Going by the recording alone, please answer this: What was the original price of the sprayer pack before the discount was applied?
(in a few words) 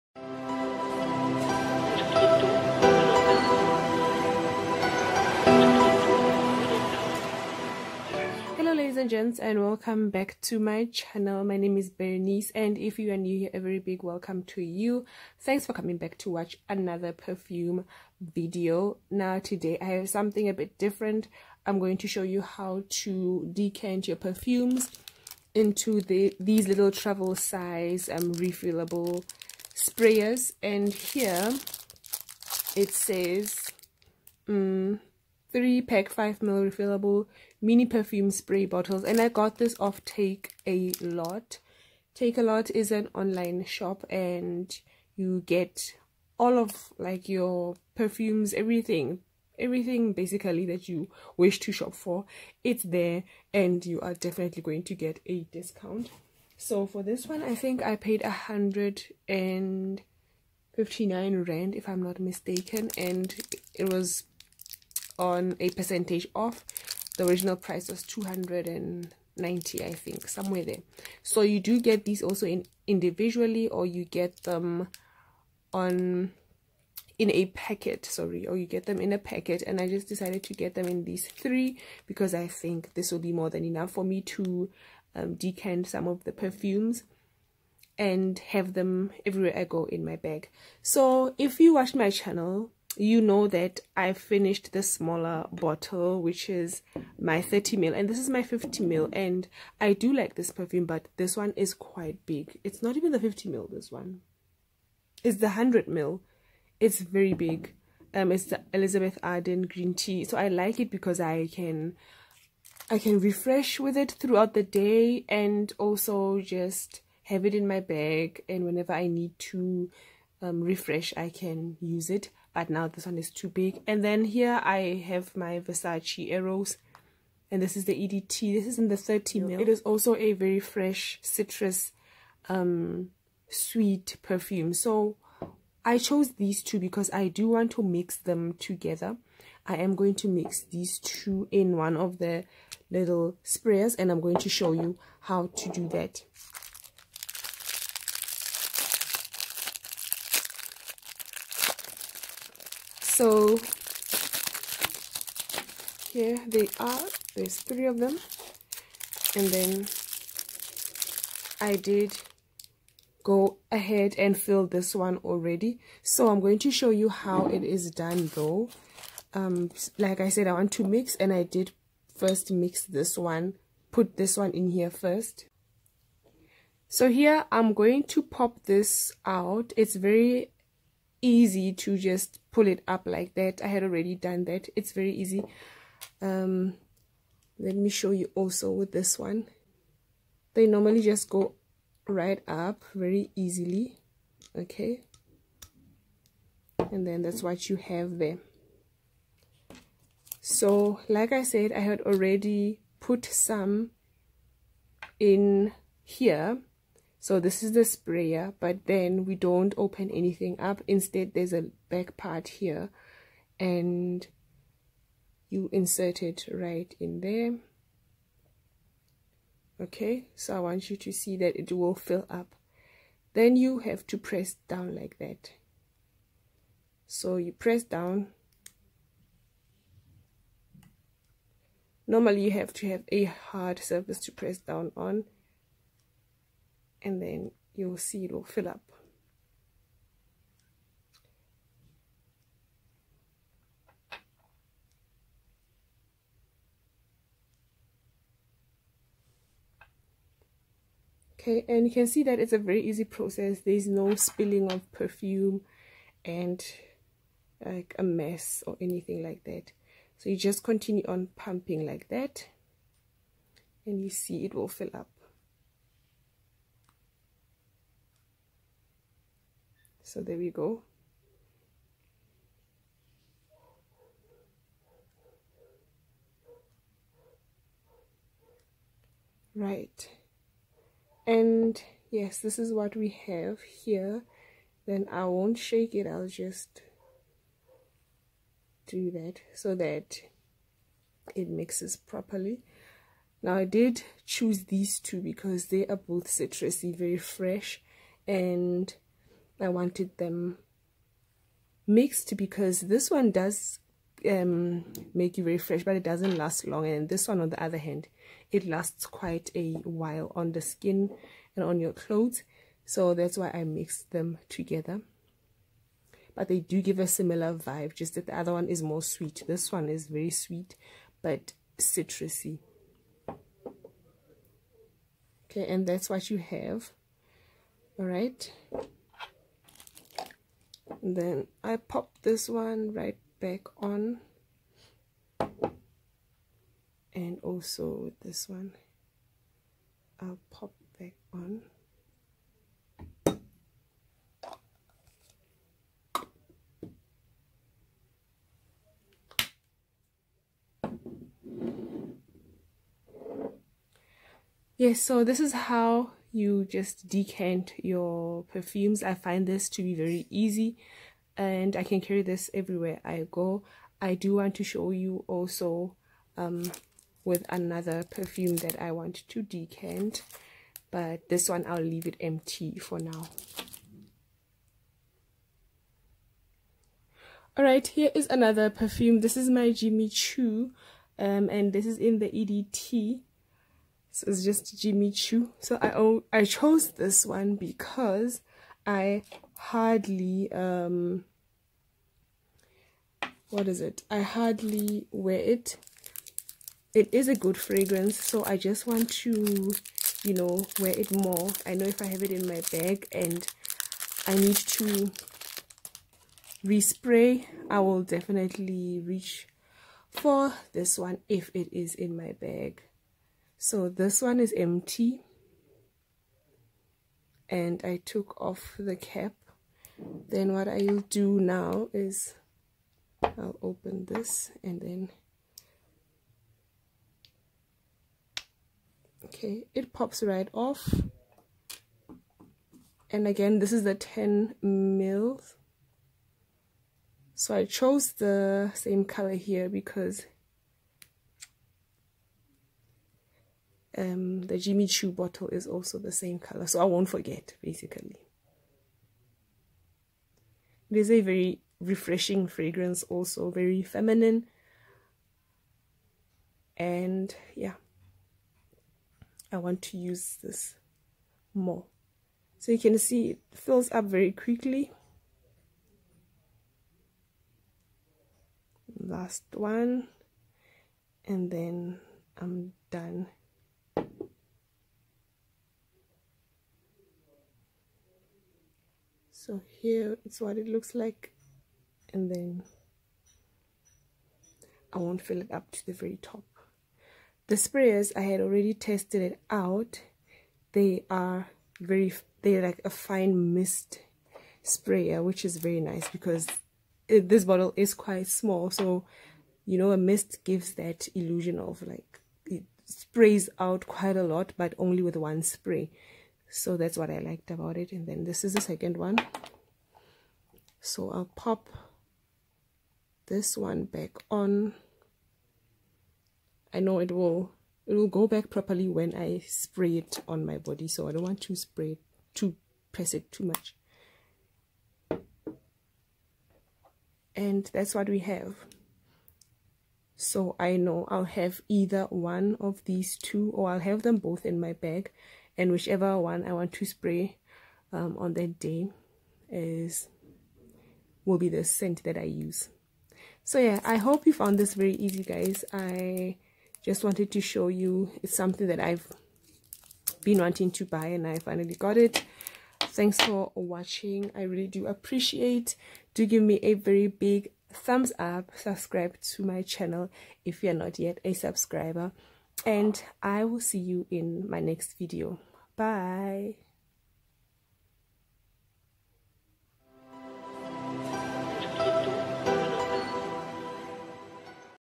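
290.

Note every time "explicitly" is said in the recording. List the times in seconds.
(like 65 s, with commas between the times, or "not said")
not said.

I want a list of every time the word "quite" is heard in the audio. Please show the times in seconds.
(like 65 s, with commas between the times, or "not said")
101 s, 309 s, 497 s, 503 s.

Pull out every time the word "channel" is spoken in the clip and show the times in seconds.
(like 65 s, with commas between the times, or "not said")
10 s, 92 s, 559 s.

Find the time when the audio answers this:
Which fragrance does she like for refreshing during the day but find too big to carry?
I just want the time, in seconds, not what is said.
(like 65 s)
108 s.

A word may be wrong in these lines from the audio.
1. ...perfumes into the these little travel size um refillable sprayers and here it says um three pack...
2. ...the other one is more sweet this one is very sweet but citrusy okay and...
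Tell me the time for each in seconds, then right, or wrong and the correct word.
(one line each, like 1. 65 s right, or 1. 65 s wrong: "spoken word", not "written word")
1. 24 s right
2. 318 s right.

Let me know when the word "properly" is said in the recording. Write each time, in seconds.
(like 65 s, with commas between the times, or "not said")
291 s, 518 s.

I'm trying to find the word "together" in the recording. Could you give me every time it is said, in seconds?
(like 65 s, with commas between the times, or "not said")
138 s, 314 s.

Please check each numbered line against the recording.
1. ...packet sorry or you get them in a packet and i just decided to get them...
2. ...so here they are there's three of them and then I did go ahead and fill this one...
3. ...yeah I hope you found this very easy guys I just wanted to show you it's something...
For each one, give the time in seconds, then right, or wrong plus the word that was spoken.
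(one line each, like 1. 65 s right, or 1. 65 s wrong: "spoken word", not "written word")
1. 77 s right
2. 153 s right
3. 543 s right.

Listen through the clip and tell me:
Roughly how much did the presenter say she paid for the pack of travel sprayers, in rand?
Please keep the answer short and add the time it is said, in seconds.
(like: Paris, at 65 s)
159 rand, at 58 s.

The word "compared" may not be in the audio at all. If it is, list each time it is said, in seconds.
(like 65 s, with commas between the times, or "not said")
not said.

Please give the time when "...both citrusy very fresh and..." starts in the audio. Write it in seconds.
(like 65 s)
295 s.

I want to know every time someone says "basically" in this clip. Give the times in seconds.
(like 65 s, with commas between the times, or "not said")
50 s, 447 s.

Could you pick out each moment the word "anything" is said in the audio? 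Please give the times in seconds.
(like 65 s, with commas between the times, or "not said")
210 s, 258 s.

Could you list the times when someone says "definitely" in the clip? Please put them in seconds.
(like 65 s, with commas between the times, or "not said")
54 s, 408 s.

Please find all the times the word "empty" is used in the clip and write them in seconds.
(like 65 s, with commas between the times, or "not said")
372 s, 414 s.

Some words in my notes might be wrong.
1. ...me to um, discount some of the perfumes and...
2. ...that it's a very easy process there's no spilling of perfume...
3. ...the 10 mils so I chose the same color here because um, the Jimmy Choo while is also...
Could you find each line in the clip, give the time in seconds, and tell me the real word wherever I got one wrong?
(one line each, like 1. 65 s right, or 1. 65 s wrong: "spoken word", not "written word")
1. 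84 s wrong: "decant", not "discount"
2. 252 s right
3. 433 s wrong: "bottle", not "while".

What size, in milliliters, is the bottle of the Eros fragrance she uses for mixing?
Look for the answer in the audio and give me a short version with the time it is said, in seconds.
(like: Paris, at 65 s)
30 ml, at 128 s.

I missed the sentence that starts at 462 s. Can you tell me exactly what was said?
So you can see it fills up very quickly.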